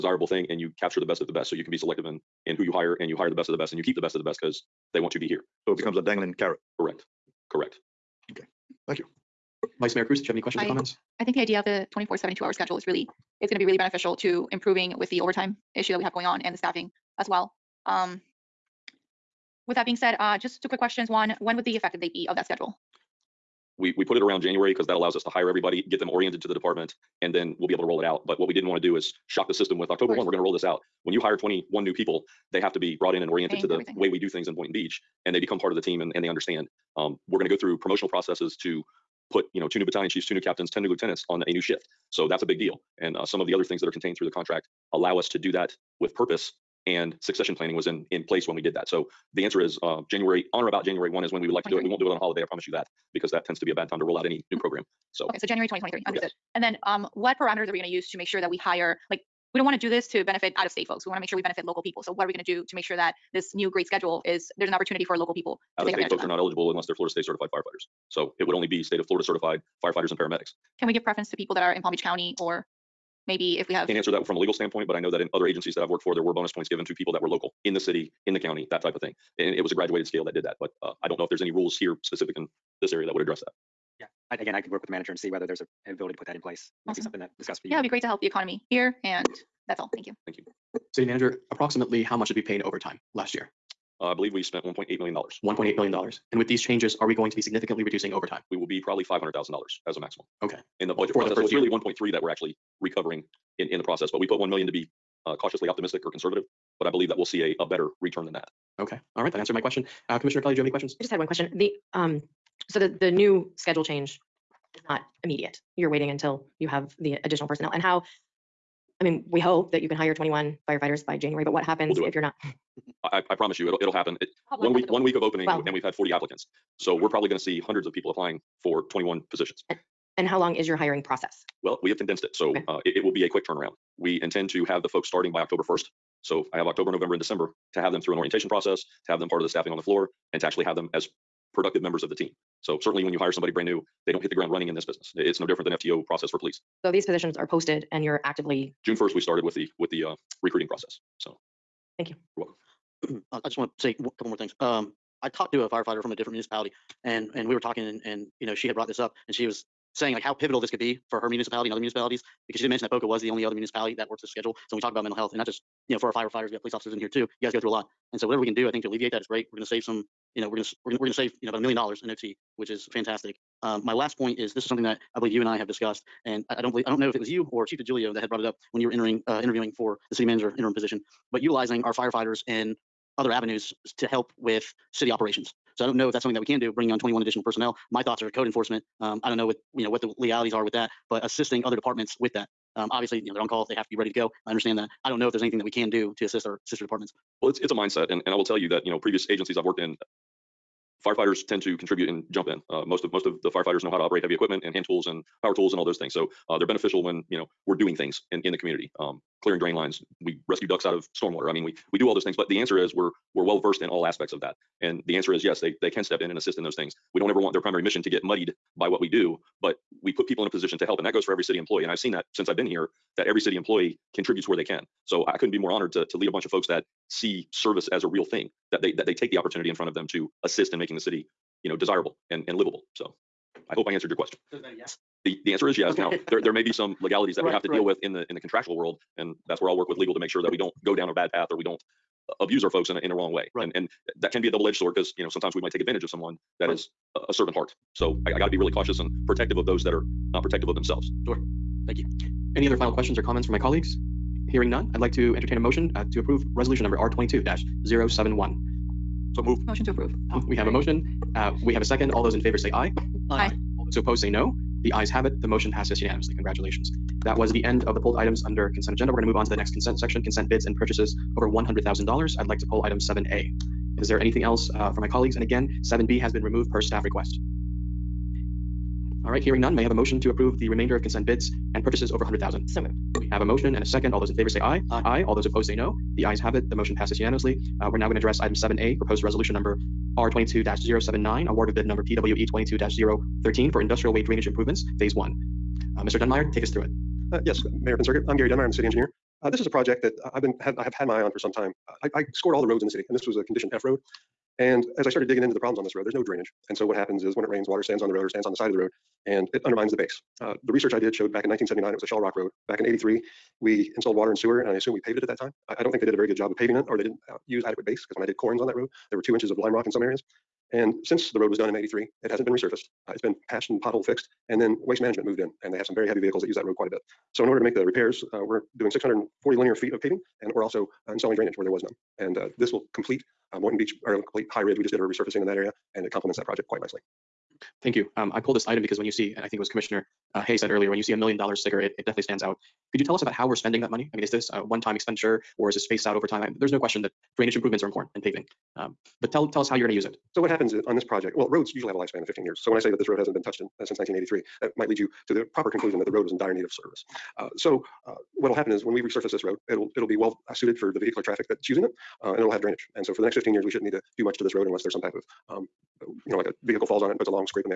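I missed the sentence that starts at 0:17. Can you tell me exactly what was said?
Um, with that being said, uh, just two quick questions.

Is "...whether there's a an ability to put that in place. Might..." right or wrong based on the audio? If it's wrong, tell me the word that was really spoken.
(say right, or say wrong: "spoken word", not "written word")
right.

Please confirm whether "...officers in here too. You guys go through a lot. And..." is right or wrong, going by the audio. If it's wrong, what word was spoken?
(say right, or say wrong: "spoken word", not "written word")
right.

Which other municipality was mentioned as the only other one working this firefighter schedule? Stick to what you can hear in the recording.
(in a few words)
Boca.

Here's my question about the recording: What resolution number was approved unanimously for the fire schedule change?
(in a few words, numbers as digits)
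R22-071.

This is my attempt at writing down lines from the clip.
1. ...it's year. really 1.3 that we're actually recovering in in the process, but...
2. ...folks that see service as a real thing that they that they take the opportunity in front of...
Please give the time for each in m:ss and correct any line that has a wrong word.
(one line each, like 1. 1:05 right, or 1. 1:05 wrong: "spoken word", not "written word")
1. 1:41 right
2. 3:46 right.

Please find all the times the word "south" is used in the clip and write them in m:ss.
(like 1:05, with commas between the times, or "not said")
not said.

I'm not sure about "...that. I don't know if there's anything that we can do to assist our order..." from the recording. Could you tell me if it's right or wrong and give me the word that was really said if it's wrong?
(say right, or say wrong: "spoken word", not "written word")
wrong: "sister", not "order".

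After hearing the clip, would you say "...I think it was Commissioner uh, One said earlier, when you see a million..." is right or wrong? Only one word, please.
wrong.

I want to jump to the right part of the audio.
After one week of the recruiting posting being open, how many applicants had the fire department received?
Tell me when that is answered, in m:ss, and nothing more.
2:05.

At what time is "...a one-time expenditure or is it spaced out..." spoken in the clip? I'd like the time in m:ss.
5:44.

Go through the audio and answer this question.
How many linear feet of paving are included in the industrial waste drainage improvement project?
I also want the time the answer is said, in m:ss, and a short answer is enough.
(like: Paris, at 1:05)
640, at 5:28.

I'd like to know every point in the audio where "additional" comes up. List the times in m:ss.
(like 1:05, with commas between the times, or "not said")
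1:57, 3:07.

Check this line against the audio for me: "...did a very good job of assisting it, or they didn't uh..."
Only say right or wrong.
wrong.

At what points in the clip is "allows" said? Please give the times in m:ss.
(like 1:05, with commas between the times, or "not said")
0:24, 0:44.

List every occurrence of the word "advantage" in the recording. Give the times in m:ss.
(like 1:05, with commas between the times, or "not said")
1:05, 4:05.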